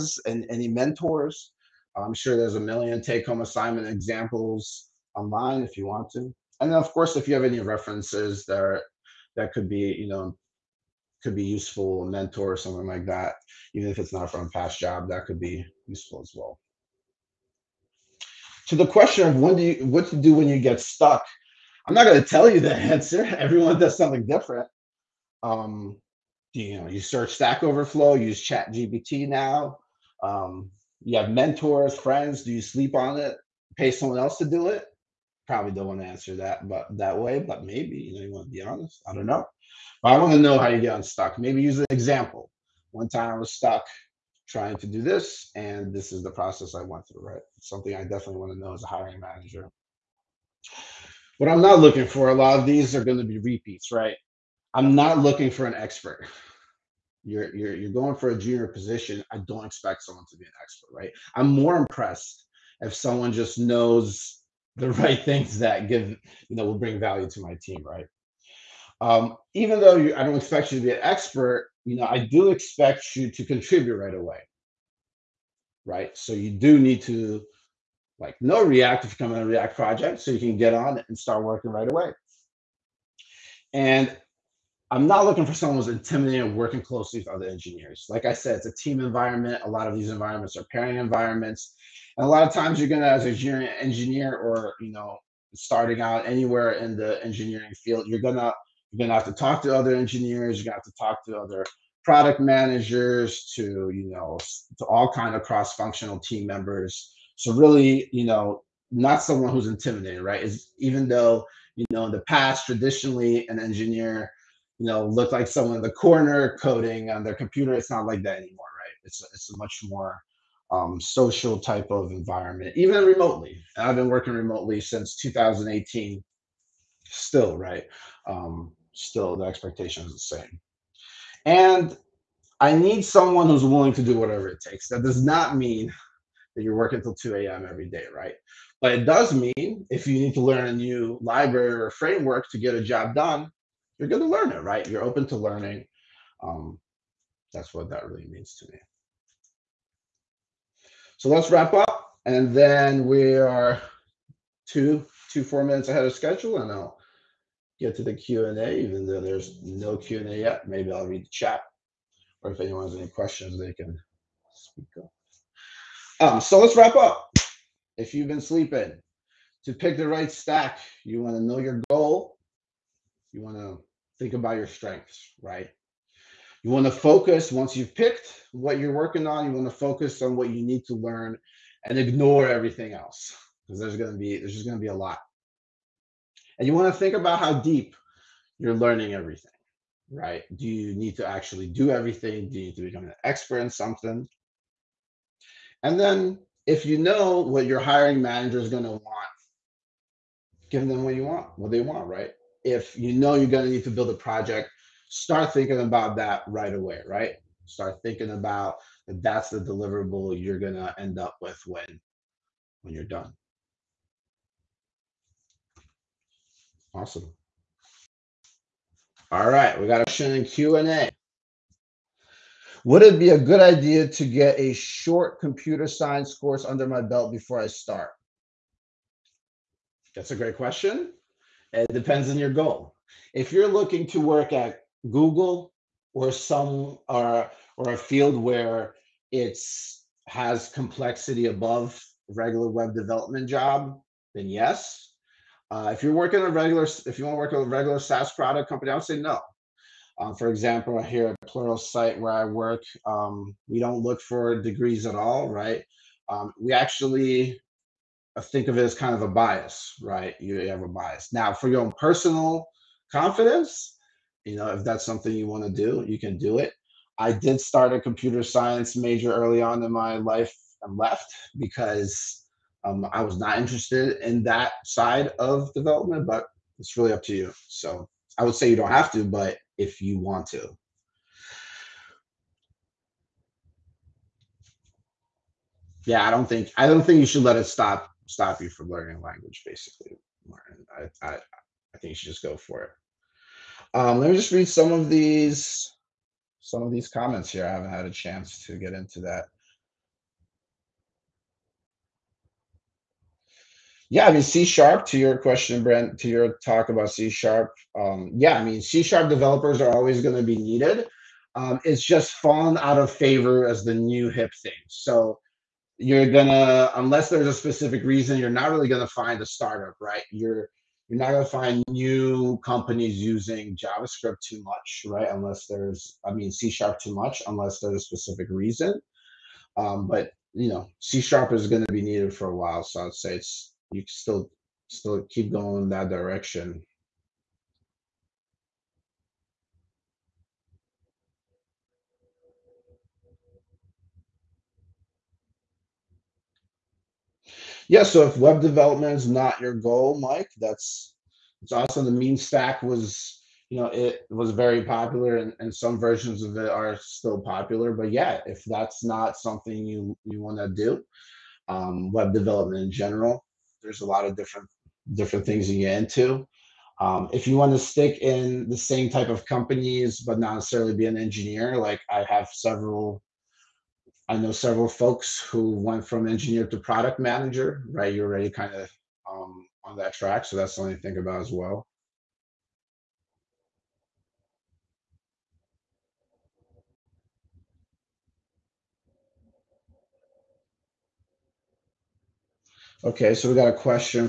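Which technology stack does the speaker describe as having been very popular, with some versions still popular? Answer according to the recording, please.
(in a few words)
MEAN stack.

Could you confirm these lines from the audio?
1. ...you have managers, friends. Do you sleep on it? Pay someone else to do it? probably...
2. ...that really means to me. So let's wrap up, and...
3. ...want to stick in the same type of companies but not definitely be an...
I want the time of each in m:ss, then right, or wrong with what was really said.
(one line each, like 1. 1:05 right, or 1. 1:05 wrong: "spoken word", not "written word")
1. 0:31 wrong: "mentors", not "managers"
2. 2:27 right
3. 6:07 wrong: "necessarily", not "definitely".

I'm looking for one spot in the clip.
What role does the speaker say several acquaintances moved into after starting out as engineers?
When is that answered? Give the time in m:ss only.
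6:16.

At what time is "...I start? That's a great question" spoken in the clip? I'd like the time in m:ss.
3:47.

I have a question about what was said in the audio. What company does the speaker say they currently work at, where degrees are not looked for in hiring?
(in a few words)
Pluralsight.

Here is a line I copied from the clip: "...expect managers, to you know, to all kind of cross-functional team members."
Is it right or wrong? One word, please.
wrong.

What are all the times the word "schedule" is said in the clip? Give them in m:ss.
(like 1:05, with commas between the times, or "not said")
2:36.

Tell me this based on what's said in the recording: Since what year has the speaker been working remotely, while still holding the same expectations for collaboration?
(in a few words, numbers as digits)
2018.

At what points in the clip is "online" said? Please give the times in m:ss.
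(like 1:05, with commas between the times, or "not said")
0:05.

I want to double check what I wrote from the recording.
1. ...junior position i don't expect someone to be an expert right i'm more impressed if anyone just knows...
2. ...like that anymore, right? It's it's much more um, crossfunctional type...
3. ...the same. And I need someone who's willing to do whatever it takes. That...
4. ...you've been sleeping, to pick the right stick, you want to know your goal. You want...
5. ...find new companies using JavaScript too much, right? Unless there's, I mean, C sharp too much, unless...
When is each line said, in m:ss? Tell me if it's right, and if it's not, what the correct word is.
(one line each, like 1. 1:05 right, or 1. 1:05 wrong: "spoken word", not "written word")
1. 0:58 wrong: "someone", not "anyone"
2. 1:58 wrong: "social", not "crossfunctional"
3. 2:10 right
4. 2:48 wrong: "stack", not "stick"
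5. 5:21 right.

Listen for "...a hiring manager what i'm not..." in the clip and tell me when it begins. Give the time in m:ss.
0:48.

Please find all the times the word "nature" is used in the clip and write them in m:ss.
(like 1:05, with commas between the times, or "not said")
not said.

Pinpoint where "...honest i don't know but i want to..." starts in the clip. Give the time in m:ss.
0:38.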